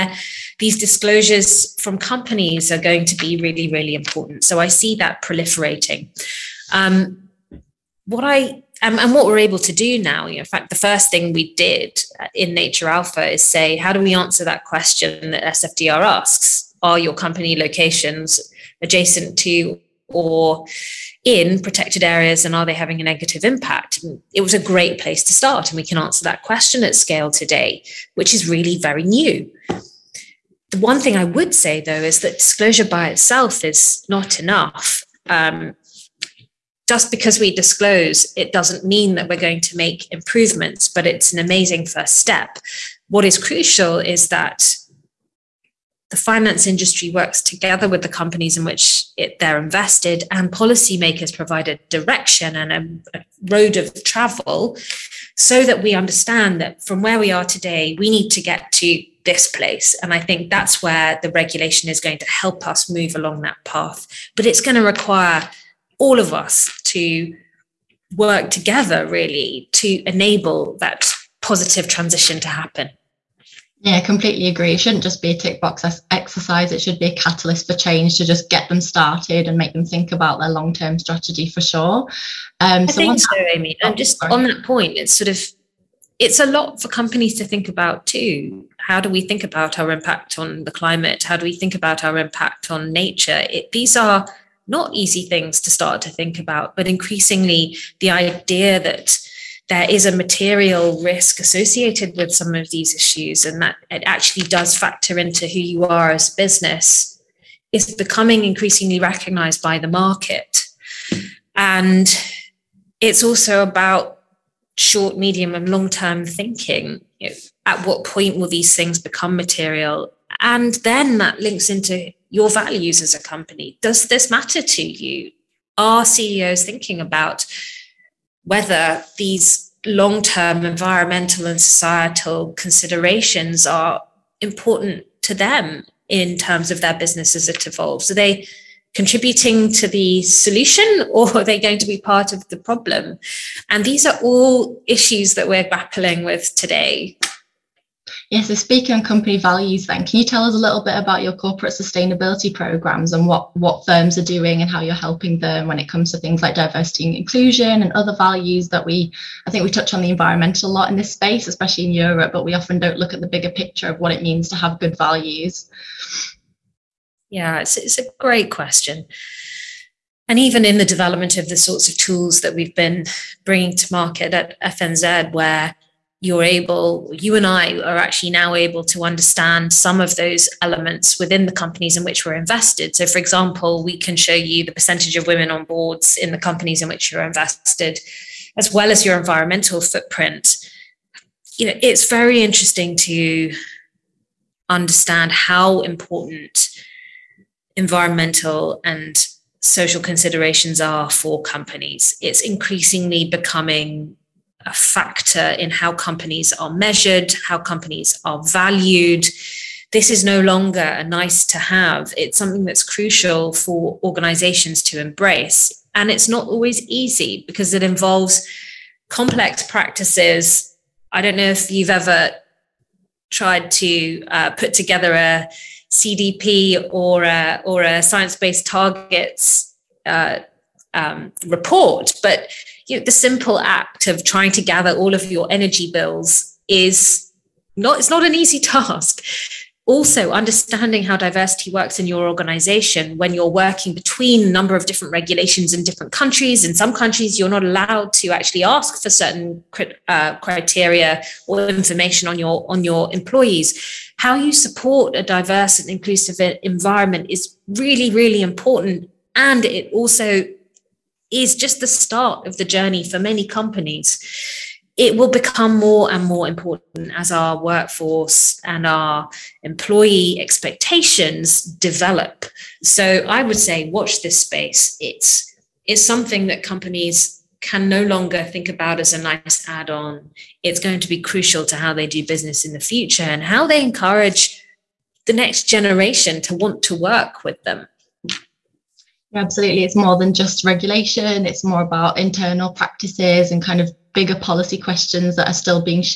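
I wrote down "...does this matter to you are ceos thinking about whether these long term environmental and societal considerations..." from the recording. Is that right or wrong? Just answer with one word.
right.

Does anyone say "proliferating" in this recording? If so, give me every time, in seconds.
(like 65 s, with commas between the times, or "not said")
5 s.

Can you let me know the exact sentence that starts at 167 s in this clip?
Yeah, it's, it's a great question.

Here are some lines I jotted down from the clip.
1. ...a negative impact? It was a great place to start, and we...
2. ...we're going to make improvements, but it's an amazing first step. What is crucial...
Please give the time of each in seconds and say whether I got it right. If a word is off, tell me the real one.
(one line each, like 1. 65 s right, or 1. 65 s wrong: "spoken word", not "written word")
1. 23 s right
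2. 39 s right.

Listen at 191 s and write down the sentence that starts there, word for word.
You know, it's very interesting to understand how important environmental and social considerations are for companies.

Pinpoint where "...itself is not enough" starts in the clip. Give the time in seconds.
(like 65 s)
33 s.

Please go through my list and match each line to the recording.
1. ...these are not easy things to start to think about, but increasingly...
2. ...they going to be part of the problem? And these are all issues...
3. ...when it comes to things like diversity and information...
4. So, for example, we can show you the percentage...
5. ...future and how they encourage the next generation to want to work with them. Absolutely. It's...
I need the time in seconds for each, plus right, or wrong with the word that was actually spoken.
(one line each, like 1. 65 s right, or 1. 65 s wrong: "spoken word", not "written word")
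1. 93 s right
2. 141 s right
3. 155 s wrong: "inclusion", not "information"
4. 182 s right
5. 282 s right.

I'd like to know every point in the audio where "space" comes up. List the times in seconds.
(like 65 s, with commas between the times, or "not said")
161 s, 274 s.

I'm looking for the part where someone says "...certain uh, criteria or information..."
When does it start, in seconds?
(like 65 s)
249 s.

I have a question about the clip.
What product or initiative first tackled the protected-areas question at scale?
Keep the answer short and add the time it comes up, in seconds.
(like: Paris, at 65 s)
Nature Alpha, at 12 s.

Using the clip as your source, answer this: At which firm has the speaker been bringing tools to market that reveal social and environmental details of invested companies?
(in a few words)
FNZ.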